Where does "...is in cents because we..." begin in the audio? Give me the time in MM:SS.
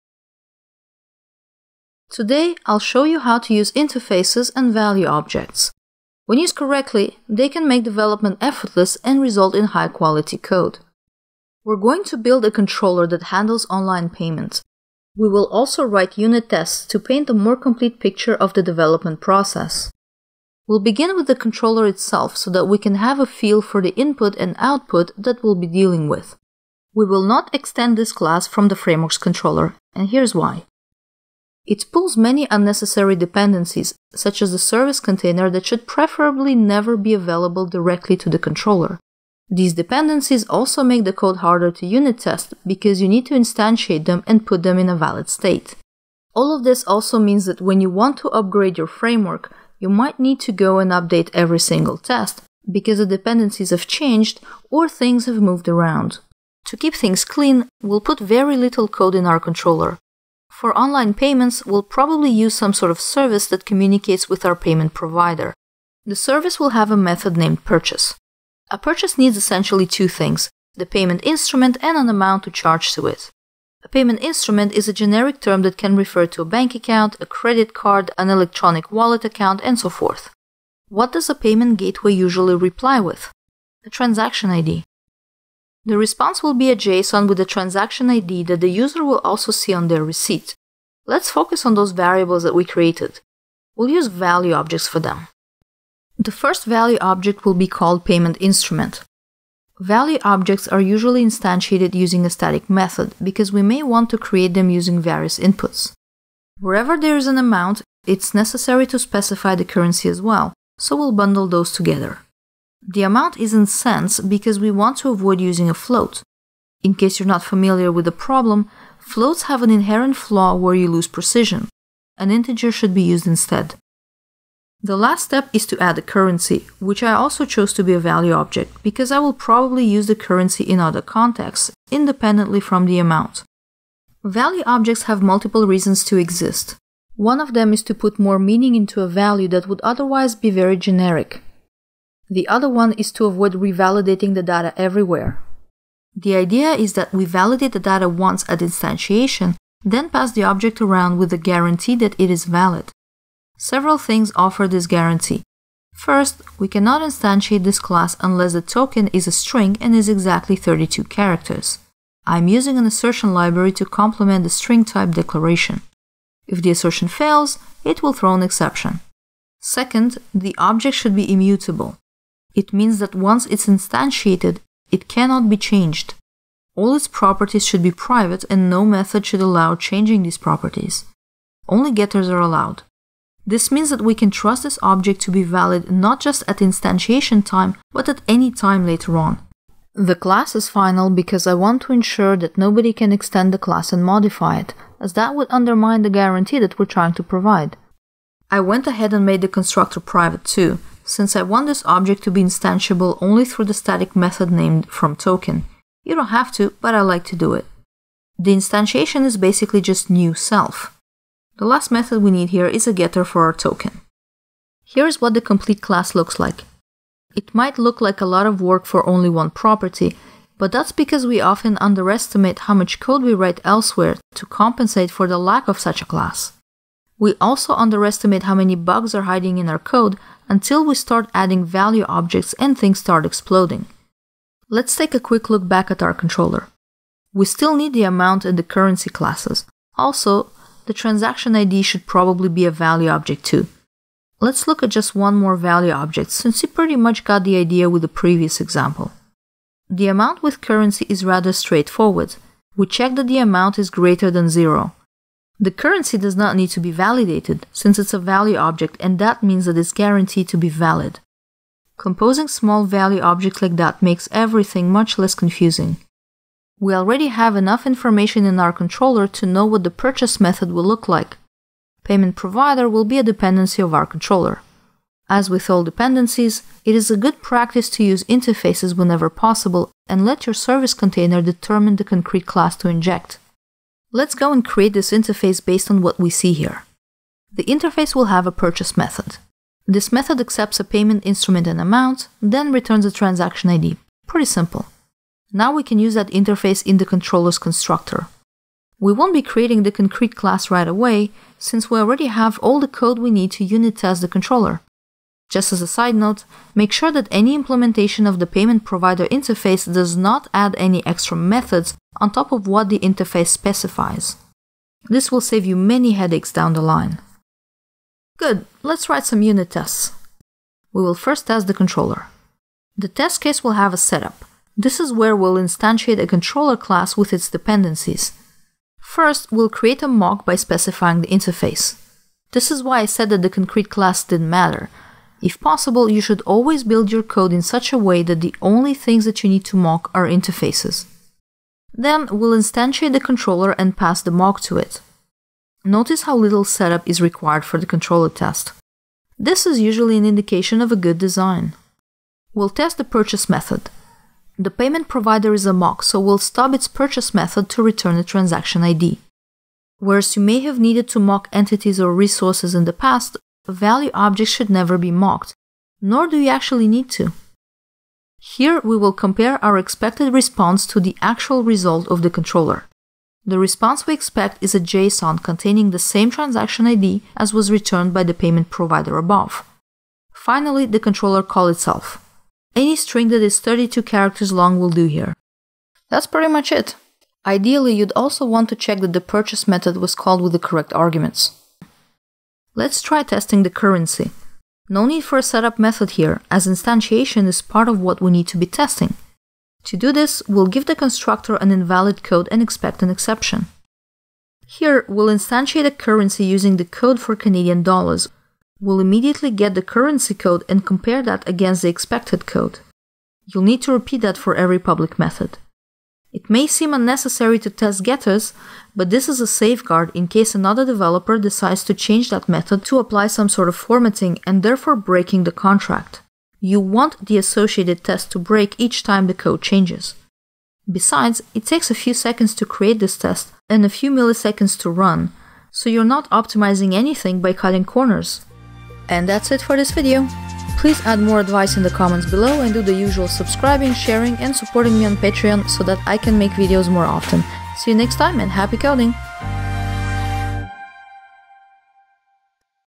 01:53.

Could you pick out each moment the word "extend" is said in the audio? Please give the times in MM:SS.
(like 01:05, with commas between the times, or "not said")
00:27, 03:13.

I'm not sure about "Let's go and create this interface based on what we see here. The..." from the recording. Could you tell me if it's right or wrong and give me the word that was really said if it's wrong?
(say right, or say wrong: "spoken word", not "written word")
right.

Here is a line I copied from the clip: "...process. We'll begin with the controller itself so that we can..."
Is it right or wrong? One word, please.
right.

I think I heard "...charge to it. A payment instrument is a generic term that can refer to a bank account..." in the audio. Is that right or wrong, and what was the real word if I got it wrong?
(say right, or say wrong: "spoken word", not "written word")
right.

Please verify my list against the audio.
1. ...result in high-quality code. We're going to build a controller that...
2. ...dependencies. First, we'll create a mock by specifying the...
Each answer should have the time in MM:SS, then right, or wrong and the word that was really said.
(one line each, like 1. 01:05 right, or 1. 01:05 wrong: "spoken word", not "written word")
1. 00:09 right
2. 05:27 right.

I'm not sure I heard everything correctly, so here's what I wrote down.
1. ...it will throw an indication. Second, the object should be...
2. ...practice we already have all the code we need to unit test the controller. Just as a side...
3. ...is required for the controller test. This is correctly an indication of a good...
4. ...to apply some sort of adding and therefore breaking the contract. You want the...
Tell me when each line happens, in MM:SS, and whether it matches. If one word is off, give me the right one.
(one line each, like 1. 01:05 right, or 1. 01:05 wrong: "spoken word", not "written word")
1. 02:47 wrong: "exception", not "indication"
2. 05:01 wrong: "since", not "practice"
3. 05:47 wrong: "usually", not "correctly"
4. 07:02 wrong: "formatting", not "adding".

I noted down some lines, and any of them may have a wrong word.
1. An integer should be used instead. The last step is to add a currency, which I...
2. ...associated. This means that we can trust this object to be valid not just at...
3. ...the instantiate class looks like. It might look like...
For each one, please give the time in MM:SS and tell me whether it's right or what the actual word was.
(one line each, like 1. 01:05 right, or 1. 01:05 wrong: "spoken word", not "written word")
1. 02:02 right
2. 03:02 wrong: "allowed", not "associated"
3. 03:35 wrong: "complete", not "instantiate".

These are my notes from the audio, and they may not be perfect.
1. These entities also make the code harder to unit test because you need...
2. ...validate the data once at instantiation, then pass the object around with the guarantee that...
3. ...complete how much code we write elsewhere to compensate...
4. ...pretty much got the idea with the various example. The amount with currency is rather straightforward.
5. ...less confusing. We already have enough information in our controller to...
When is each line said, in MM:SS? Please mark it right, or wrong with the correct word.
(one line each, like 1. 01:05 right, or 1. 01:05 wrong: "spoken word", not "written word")
1. 00:39 wrong: "dependencies", not "entities"
2. 02:27 right
3. 03:41 wrong: "underestimate", not "complete"
4. 04:06 wrong: "previous", not "various"
5. 04:25 right.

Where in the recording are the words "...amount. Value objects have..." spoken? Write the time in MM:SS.
02:12.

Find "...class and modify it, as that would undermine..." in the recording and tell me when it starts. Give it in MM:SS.
03:13.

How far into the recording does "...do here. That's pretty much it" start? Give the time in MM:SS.
06:24.